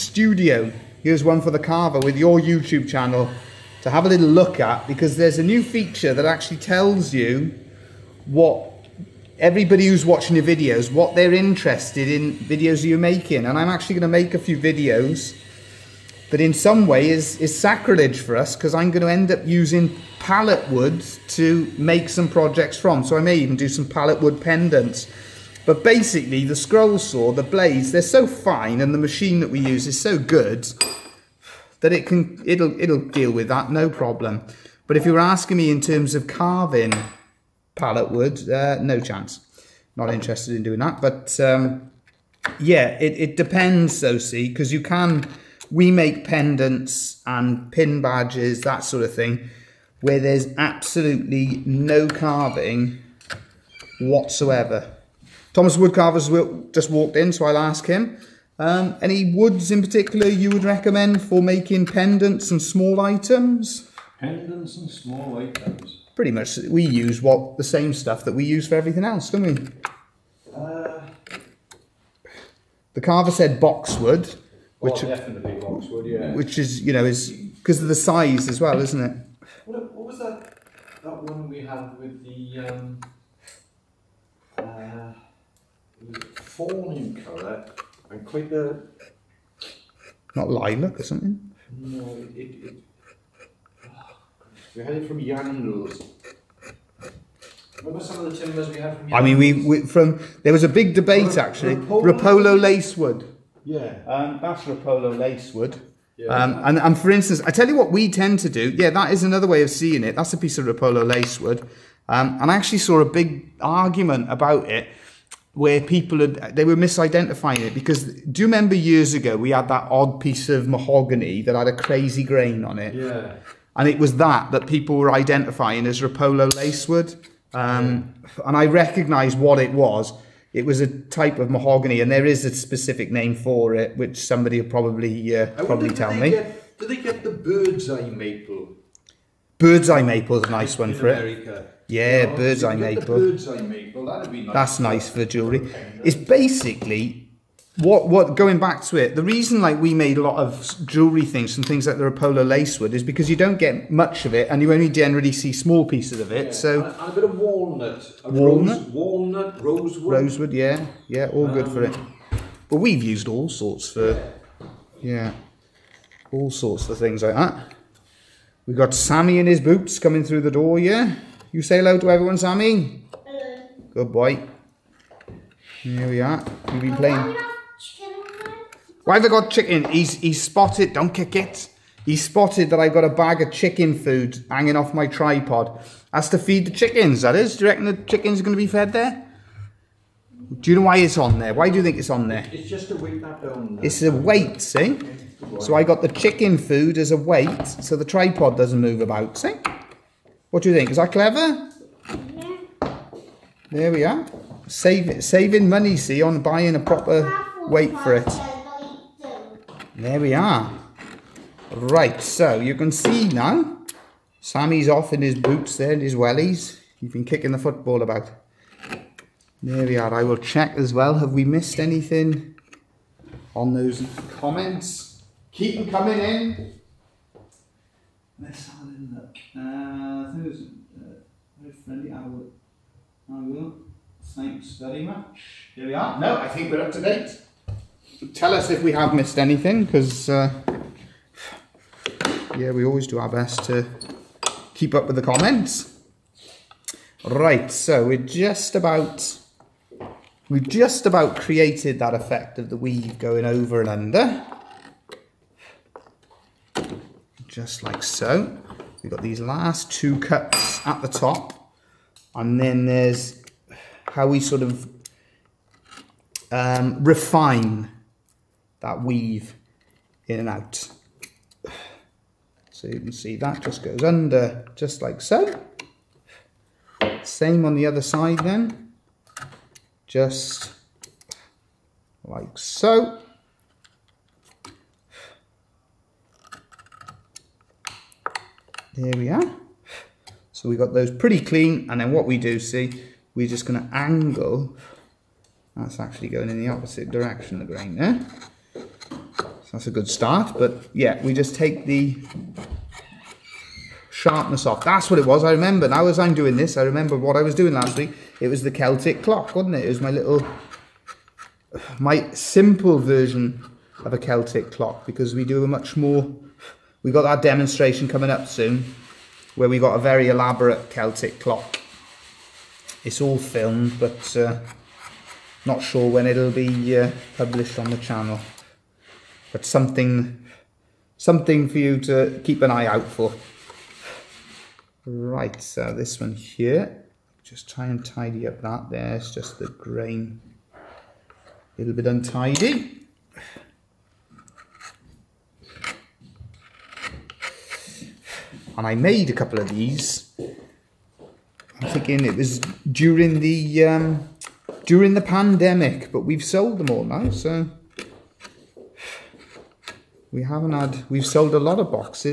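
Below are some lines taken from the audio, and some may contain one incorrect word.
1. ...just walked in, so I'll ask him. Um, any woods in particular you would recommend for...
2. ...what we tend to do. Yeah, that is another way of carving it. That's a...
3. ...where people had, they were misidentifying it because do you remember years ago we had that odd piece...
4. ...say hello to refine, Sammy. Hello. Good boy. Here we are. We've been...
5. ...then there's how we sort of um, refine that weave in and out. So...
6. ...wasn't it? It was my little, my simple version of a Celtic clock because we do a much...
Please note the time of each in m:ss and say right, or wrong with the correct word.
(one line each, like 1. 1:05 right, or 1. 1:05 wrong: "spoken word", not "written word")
1. 0:56 right
2. 1:47 wrong: "seeing", not "carving"
3. 1:55 right
4. 2:51 wrong: "everyone", not "refine"
5. 4:22 right
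6. 5:09 right.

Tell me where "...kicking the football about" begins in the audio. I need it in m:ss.
3:37.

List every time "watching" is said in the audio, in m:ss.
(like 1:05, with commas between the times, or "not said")
0:10.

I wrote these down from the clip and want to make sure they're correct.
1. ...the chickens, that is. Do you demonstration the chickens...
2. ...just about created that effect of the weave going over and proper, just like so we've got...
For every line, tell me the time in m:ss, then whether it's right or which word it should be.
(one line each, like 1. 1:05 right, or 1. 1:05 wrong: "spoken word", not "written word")
1. 3:06 wrong: "reckon", not "demonstration"
2. 4:10 wrong: "under", not "proper".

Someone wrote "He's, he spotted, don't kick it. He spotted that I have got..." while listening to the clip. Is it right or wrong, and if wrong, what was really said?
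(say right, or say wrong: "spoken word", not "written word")
right.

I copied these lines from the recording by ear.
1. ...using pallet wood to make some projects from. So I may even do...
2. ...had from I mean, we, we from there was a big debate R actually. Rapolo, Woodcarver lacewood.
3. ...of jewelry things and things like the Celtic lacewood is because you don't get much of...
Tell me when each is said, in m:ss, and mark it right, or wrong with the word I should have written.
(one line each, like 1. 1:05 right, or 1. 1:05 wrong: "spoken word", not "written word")
1. 0:19 right
2. 1:38 wrong: "Rapolo", not "Woodcarver"
3. 2:30 wrong: "Rapola", not "Celtic".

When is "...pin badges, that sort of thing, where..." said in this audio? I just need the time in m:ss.
0:47.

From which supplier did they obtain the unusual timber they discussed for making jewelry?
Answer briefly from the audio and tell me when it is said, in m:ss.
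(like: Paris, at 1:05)
Yandos, at 1:35.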